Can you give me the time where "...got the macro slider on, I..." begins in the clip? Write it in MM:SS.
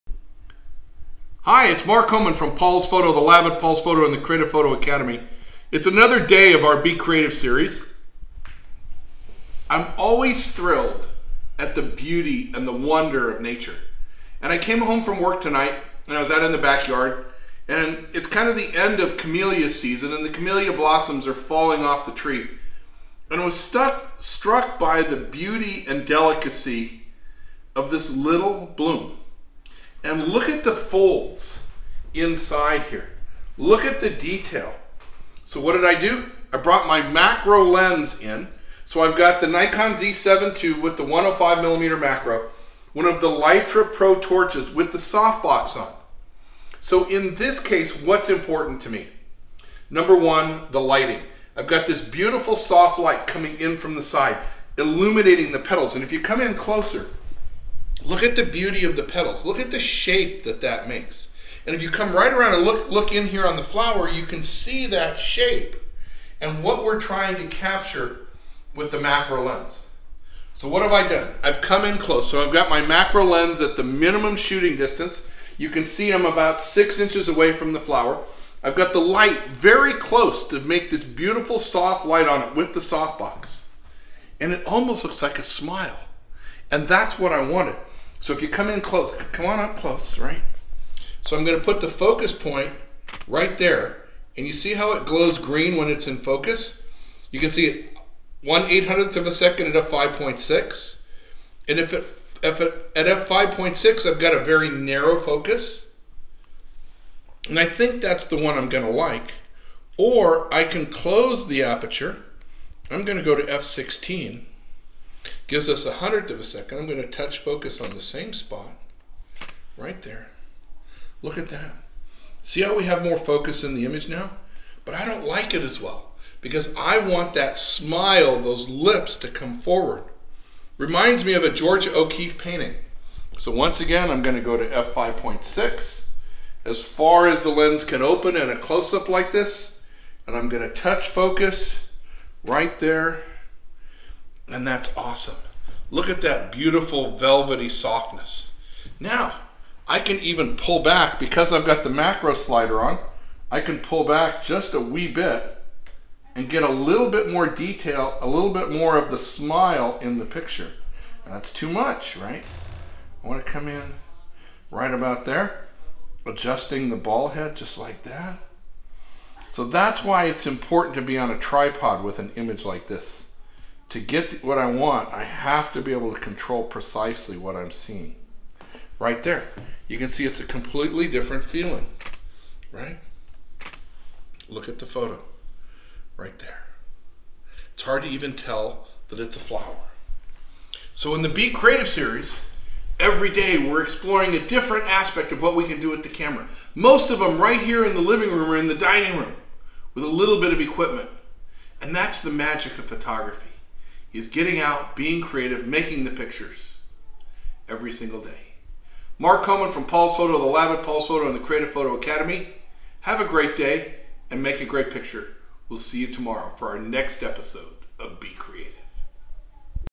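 02:31.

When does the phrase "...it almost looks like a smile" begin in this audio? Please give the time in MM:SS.
01:24.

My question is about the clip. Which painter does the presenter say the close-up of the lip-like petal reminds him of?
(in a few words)
George O'Keeffe.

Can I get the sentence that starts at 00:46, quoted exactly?
So in this case, what's important to me?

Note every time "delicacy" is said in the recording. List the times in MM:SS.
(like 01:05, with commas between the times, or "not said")
00:26.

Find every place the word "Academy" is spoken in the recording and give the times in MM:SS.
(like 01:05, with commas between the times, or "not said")
00:04, 03:31.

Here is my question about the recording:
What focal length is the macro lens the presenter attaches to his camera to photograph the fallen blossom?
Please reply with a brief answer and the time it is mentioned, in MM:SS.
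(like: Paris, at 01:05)
105 millimeter, at 00:41.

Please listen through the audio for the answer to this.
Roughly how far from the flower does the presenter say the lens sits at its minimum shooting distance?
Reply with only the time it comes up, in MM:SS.
01:16.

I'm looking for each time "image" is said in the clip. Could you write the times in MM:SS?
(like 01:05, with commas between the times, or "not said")
02:03, 02:52.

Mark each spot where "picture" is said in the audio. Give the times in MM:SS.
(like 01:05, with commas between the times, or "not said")
02:40, 03:26, 03:34.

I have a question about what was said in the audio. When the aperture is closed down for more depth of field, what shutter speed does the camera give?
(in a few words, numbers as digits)
1/100 second.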